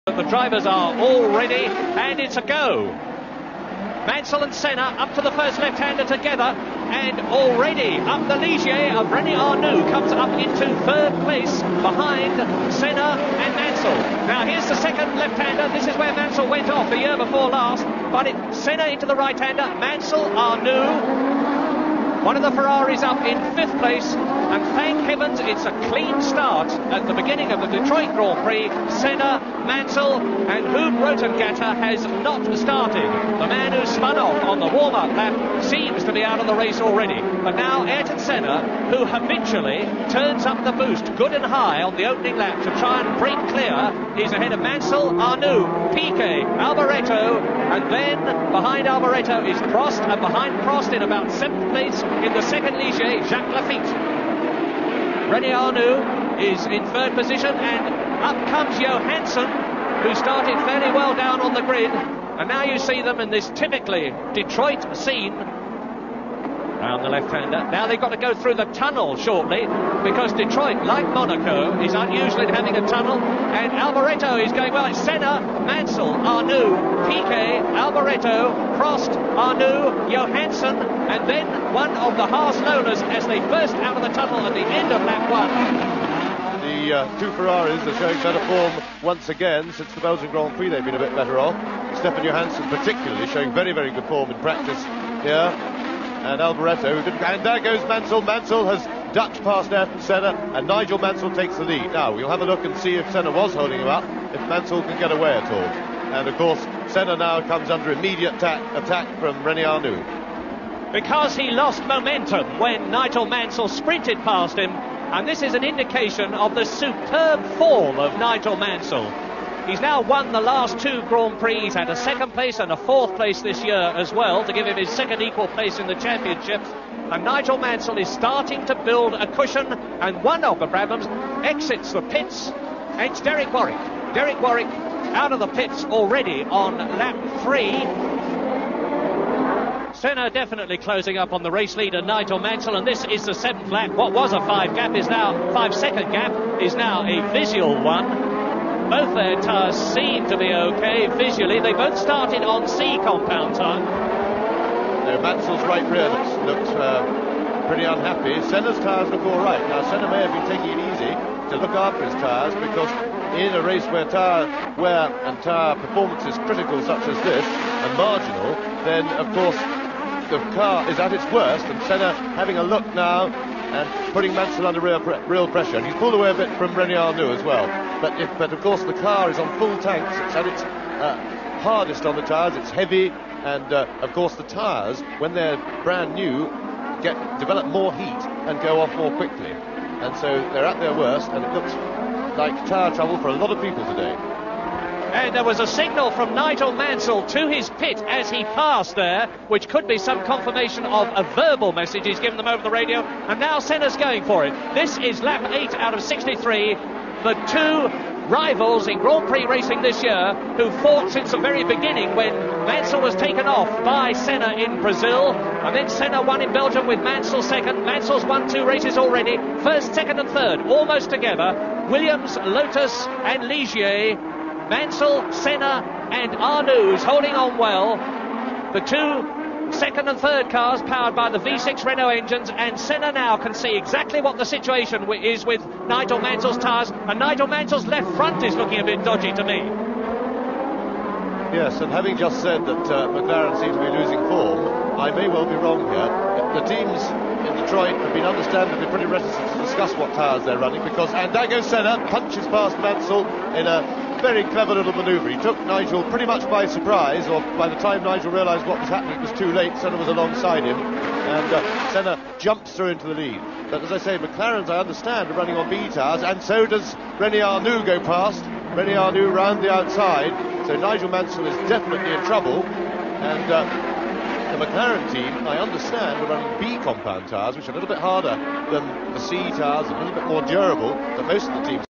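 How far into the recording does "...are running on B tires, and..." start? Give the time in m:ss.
4:25.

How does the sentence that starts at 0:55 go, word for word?
René Arnoux is in third position, and up comes Johansson, who started fairly well down on the grid.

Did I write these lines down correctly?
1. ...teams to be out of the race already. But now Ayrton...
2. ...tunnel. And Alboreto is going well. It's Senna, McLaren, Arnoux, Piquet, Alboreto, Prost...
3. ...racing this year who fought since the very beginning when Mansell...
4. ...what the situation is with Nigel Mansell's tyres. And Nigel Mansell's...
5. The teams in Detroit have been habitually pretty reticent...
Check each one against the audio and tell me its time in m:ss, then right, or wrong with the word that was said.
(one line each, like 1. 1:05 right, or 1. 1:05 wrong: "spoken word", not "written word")
1. 0:35 wrong: "seems", not "teams"
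2. 1:12 wrong: "Mansell", not "McLaren"
3. 3:29 right
4. 3:54 right
5. 4:06 wrong: "understandably", not "habitually".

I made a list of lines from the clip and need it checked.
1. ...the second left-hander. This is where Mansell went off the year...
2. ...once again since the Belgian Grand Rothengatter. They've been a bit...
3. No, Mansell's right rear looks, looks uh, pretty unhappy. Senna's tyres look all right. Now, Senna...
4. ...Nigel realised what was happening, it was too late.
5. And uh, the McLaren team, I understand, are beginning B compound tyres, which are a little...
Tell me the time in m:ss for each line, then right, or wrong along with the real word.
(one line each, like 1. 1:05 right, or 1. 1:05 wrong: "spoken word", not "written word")
1. 0:14 right
2. 1:29 wrong: "Prix", not "Rothengatter"
3. 2:35 right
4. 4:18 right
5. 4:32 wrong: "running", not "beginning".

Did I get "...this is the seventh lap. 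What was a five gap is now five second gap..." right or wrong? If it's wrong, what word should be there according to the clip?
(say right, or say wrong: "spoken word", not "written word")
right.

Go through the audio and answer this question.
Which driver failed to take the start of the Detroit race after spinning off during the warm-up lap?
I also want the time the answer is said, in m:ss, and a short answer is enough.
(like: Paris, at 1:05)
Huub Rothengatter, at 0:30.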